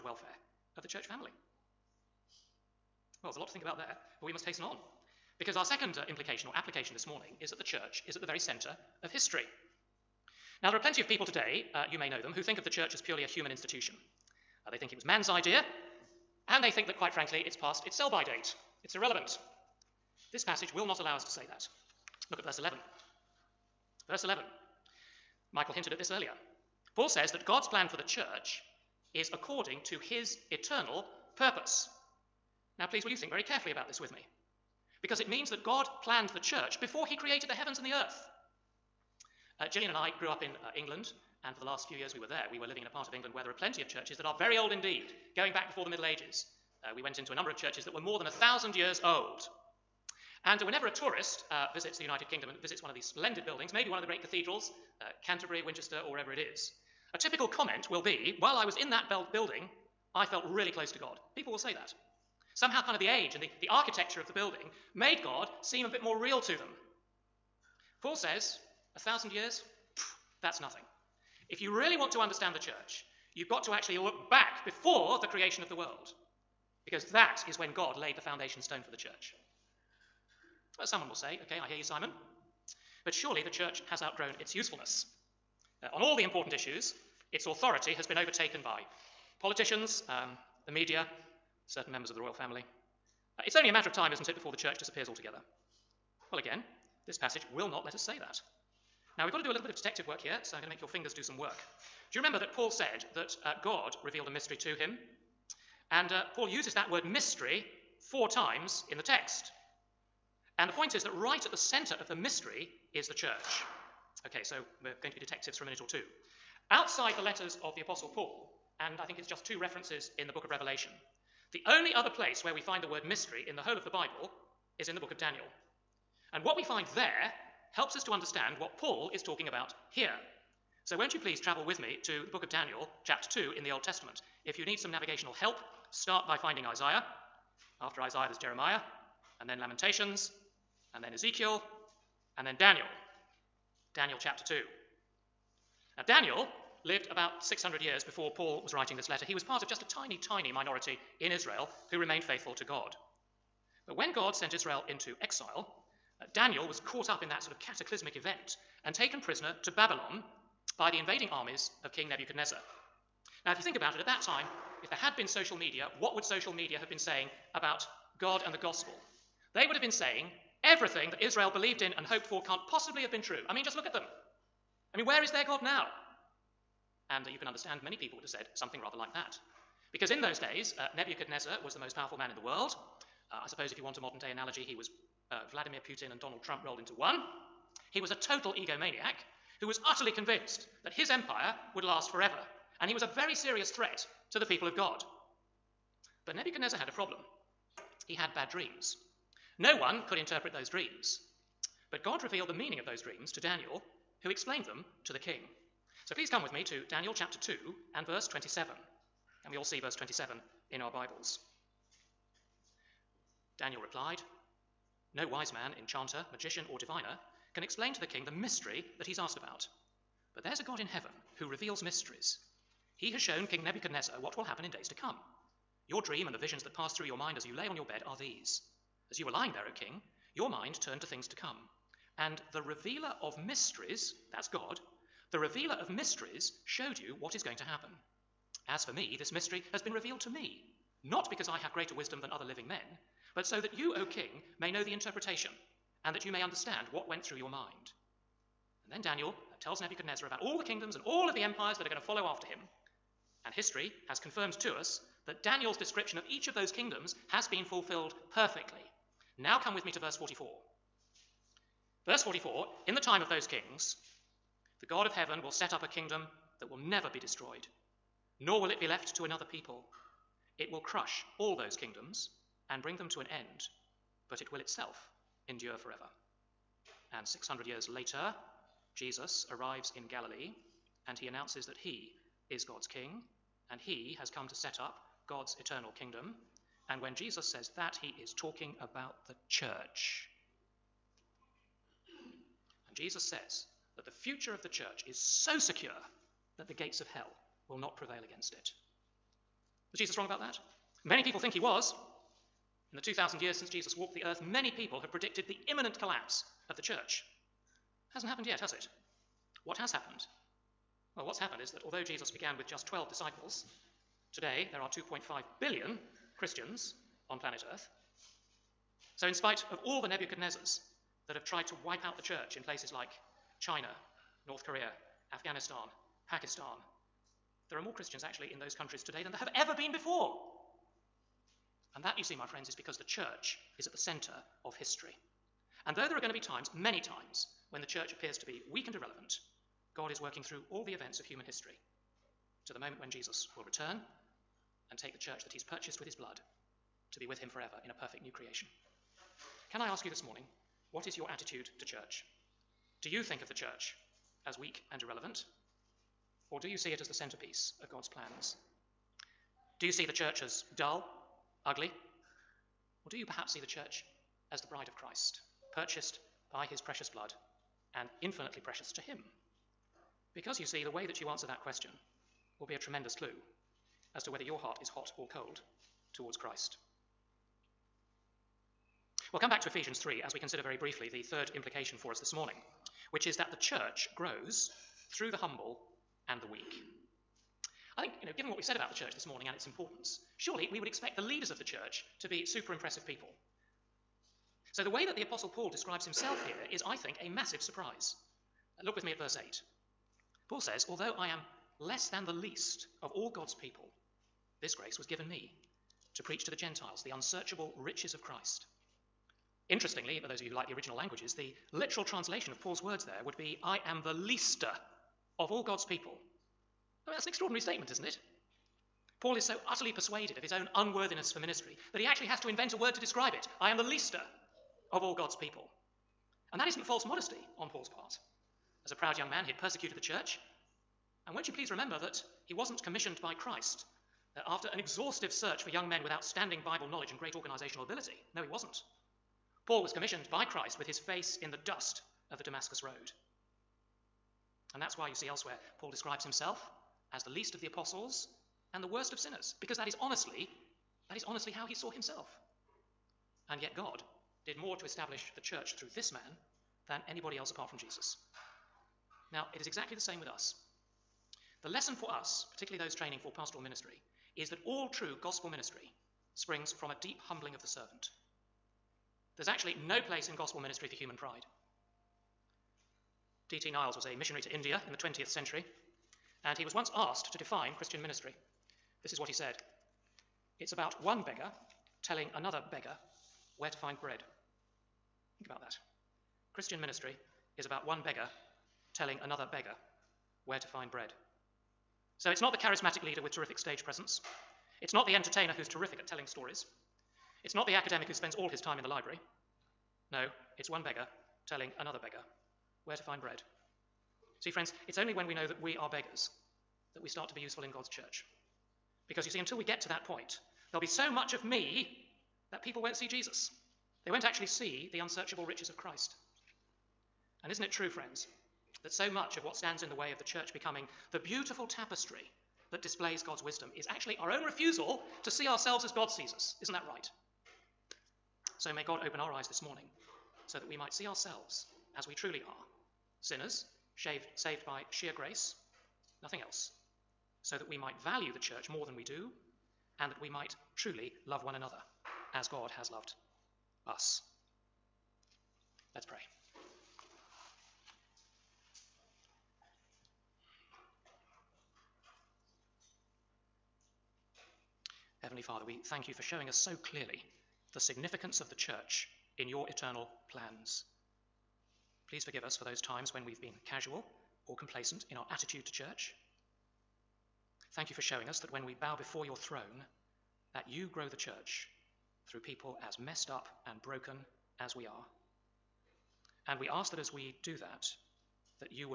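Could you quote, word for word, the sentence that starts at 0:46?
Uh, we went into a number of churches that were more than a thousand years old.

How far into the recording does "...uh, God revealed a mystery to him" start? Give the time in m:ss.
1:43.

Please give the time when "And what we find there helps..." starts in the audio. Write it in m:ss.
2:06.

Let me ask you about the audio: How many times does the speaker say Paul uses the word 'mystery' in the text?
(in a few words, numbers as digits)
4.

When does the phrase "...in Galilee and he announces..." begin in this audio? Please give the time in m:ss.
4:39.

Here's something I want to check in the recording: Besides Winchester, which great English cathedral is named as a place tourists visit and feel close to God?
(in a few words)
Canterbury.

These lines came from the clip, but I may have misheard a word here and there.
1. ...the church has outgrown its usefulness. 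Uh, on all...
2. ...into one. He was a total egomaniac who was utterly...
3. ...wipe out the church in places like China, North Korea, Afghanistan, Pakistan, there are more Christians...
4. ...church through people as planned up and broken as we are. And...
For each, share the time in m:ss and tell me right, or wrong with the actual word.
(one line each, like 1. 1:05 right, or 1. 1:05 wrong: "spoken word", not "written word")
1. 1:23 right
2. 3:06 right
3. 5:21 right
4. 9:31 wrong: "messed", not "planned".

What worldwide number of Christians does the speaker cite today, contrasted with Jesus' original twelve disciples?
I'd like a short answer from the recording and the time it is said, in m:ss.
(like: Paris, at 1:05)
2.5 billion, at 5:14.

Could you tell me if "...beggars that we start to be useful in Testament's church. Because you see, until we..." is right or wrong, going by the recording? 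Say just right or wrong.
wrong.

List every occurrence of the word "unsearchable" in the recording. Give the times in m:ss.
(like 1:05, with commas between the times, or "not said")
6:47, 8:34.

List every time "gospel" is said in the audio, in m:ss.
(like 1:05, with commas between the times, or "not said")
2:48, 7:45, 7:50.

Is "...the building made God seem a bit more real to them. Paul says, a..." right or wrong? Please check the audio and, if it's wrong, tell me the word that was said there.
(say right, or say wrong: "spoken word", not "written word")
right.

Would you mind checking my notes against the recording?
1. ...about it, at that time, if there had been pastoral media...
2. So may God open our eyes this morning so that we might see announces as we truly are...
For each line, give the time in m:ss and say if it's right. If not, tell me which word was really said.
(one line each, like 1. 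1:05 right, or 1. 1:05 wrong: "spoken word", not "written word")
1. 2:43 wrong: "social", not "pastoral"
2. 8:48 wrong: "ourselves", not "announces".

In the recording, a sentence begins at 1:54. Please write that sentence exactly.
Okay, so we're going to be detectives for a minute or two.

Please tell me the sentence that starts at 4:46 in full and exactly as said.
And when Jesus says that, he is talking about the church.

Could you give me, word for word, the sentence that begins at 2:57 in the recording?
And uh, you can understand many people would have said something rather like that.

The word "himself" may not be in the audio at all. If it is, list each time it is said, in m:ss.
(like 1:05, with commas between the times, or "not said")
6:36, 7:26, 7:31.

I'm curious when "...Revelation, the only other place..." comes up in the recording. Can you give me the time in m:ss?
2:00.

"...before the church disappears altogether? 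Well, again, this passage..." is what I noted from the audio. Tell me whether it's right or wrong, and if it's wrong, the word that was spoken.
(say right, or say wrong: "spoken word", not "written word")
right.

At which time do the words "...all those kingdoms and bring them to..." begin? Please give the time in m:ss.
4:31.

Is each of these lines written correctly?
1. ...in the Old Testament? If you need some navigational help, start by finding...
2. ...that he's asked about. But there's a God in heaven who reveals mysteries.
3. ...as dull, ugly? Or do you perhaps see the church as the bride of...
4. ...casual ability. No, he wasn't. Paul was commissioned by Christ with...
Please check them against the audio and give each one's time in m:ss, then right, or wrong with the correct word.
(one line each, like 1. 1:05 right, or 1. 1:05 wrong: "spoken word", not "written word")
1. 2:13 right
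2. 3:38 right
3. 6:00 right
4. 7:17 wrong: "organizational", not "casual".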